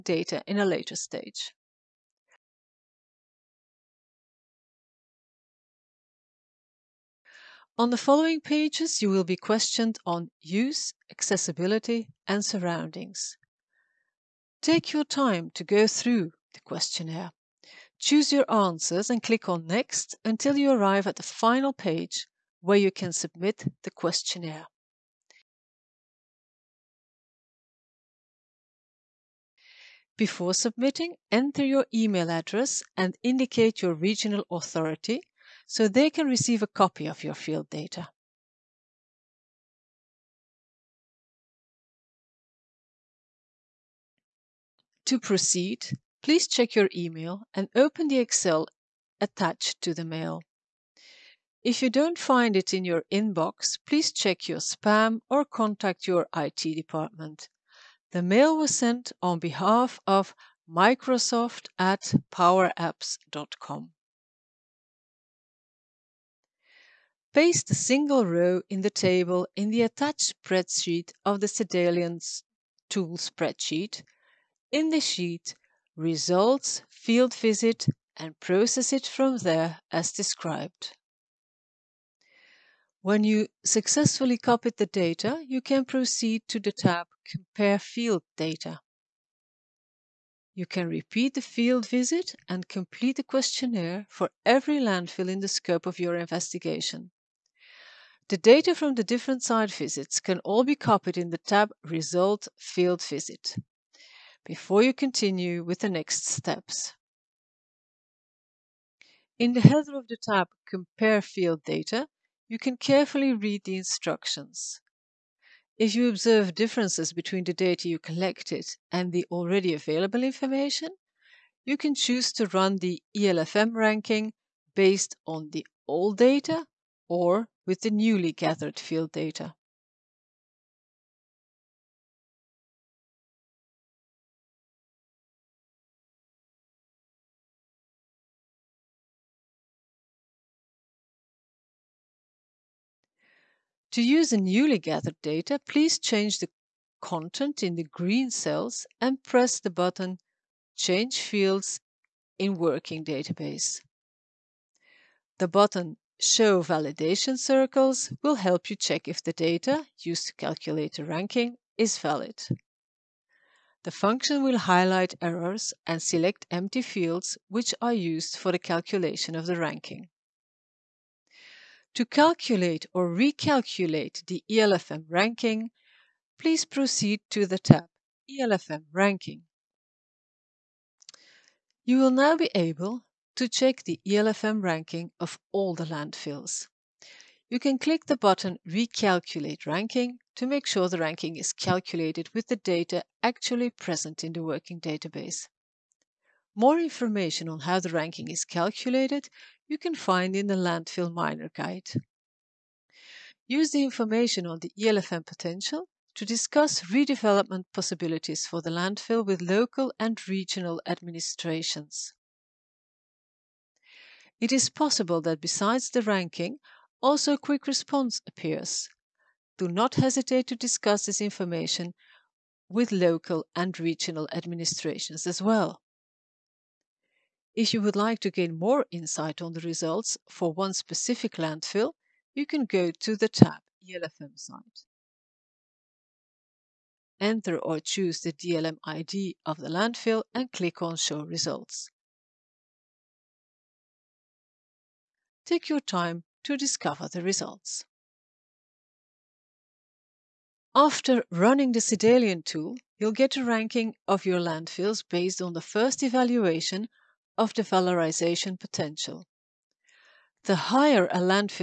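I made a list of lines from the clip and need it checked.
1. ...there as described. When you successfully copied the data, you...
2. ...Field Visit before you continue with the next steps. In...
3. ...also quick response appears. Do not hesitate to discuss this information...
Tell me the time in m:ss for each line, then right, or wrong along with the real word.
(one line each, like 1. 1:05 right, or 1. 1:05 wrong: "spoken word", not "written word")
1. 1:19 right
2. 1:42 right
3. 3:37 right.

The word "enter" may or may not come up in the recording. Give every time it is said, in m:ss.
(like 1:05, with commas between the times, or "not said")
0:31, 3:57.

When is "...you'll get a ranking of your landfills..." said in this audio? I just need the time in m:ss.
4:12.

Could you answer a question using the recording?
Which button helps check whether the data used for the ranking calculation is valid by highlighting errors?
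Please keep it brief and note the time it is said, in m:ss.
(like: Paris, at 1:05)
Show Validation Circles, at 2:36.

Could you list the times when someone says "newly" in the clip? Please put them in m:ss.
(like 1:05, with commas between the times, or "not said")
2:08, 2:24.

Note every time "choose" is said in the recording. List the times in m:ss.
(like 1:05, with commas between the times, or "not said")
0:17, 2:01, 3:57.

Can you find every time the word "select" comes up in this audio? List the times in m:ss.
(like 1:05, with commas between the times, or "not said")
2:46.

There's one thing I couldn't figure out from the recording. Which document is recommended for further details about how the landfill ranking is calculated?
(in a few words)
Landfill Miner Guide.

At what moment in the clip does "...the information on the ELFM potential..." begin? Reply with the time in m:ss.
3:23.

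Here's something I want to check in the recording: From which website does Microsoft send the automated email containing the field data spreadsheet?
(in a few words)
powerapps.com.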